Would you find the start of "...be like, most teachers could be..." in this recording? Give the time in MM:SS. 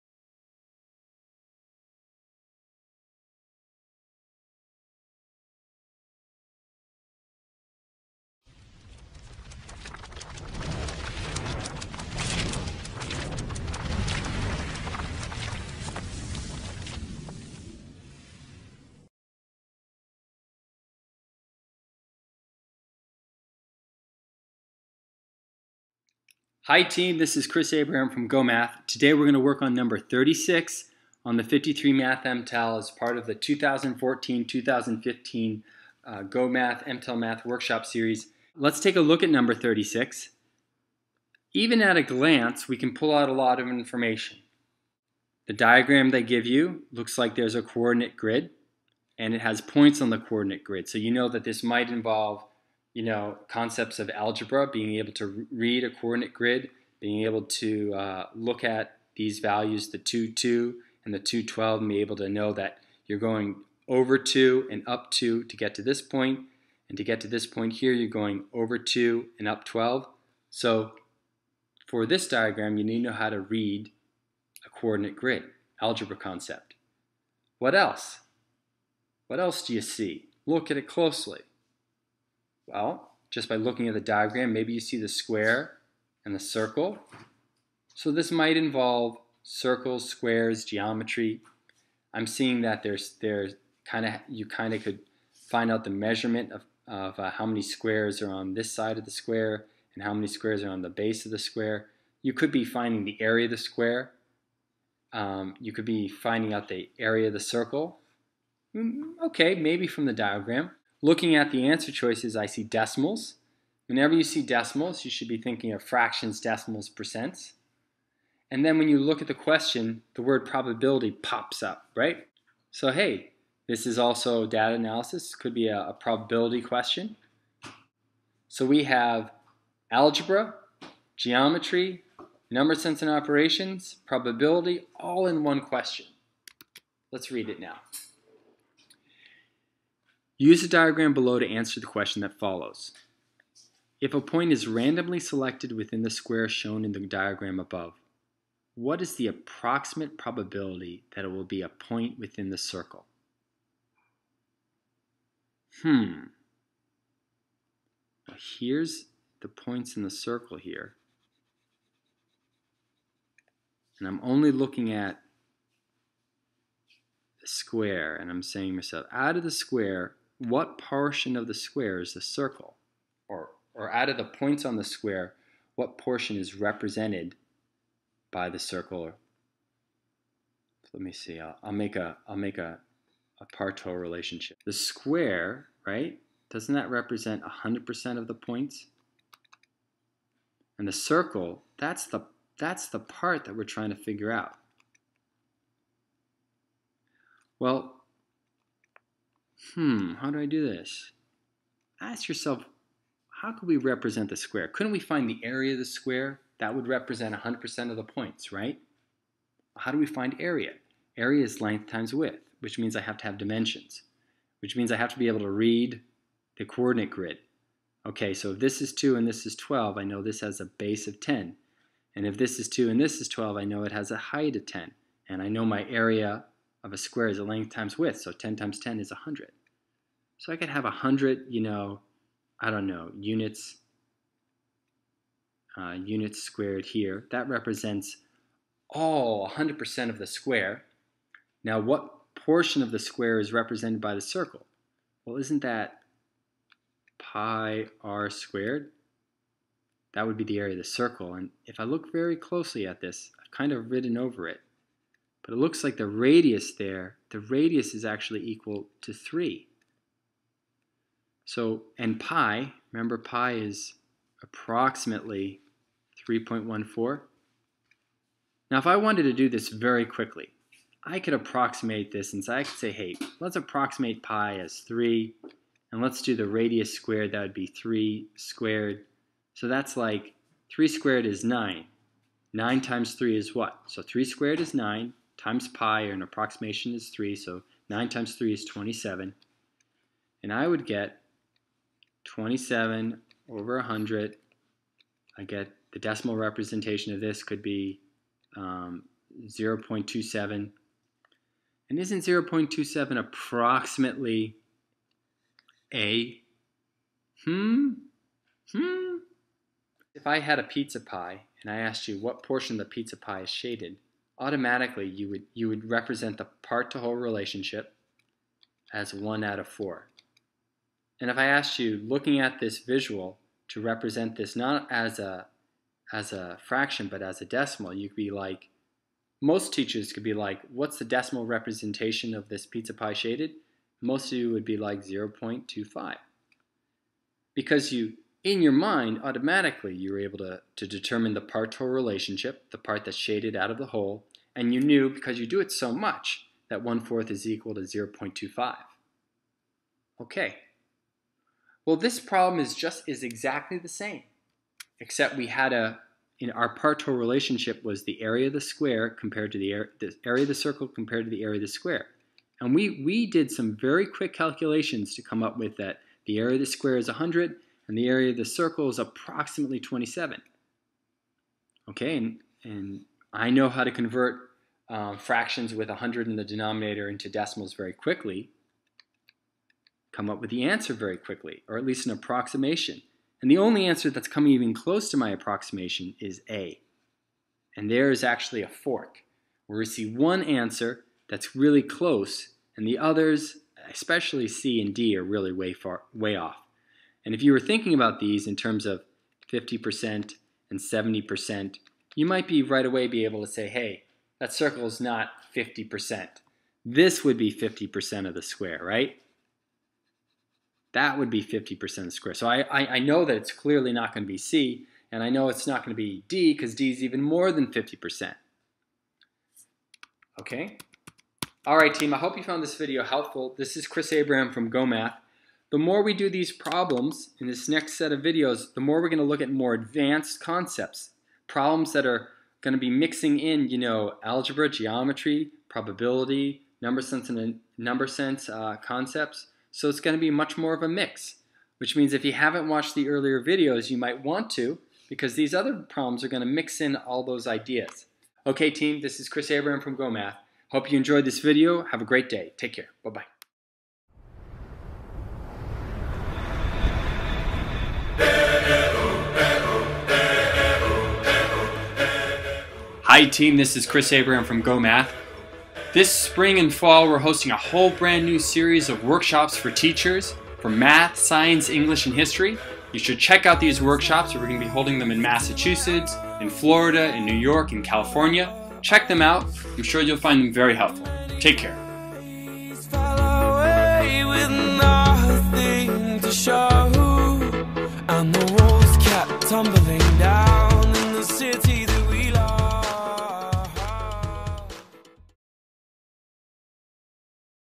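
05:28.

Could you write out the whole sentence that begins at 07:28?
Okay, team, this is Chris Abraham from GOHmath.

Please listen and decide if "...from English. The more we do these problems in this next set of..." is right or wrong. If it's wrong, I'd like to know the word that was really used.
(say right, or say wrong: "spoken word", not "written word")
wrong: "GOHmath", not "English".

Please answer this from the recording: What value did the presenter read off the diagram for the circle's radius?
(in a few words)
3.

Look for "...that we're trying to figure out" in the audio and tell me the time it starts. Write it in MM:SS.
03:13.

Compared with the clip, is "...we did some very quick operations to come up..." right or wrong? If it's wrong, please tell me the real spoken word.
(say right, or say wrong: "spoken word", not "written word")
wrong: "calculations", not "operations".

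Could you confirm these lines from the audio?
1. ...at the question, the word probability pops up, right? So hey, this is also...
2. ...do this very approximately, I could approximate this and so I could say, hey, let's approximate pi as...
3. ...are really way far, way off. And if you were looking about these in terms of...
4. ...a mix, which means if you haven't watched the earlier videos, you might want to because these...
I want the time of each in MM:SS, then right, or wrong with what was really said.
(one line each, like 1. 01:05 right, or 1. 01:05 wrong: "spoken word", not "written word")
1. 01:59 right
2. 04:29 wrong: "quickly", not "approximately"
3. 06:35 wrong: "thinking", not "looking"
4. 07:20 right.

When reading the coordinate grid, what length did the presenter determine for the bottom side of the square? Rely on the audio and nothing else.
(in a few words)
10.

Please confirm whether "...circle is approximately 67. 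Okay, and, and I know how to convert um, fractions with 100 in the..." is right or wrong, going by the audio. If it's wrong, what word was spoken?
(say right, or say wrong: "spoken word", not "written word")
wrong: "27", not "67".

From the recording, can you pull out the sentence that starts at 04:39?
So that's like 3 squared is 9.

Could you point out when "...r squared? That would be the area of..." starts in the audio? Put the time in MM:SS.
04:08.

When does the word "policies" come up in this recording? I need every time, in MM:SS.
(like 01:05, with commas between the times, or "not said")
not said.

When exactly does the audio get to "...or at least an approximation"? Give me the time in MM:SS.
06:21.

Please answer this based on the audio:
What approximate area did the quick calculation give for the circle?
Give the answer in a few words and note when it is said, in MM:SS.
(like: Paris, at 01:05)
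27, at 04:47.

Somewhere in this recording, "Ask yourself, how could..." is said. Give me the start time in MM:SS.
03:21.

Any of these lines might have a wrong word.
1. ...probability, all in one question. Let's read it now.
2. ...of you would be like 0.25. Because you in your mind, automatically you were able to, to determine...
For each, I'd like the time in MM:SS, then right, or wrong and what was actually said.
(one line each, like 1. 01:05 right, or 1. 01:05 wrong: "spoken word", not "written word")
1. 02:14 right
2. 05:34 right.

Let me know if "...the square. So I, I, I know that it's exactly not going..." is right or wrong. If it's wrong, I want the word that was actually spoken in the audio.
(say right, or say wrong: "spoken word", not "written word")
wrong: "clearly", not "exactly".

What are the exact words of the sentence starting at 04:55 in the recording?
I get the decimal representation of this could be um, 0.27.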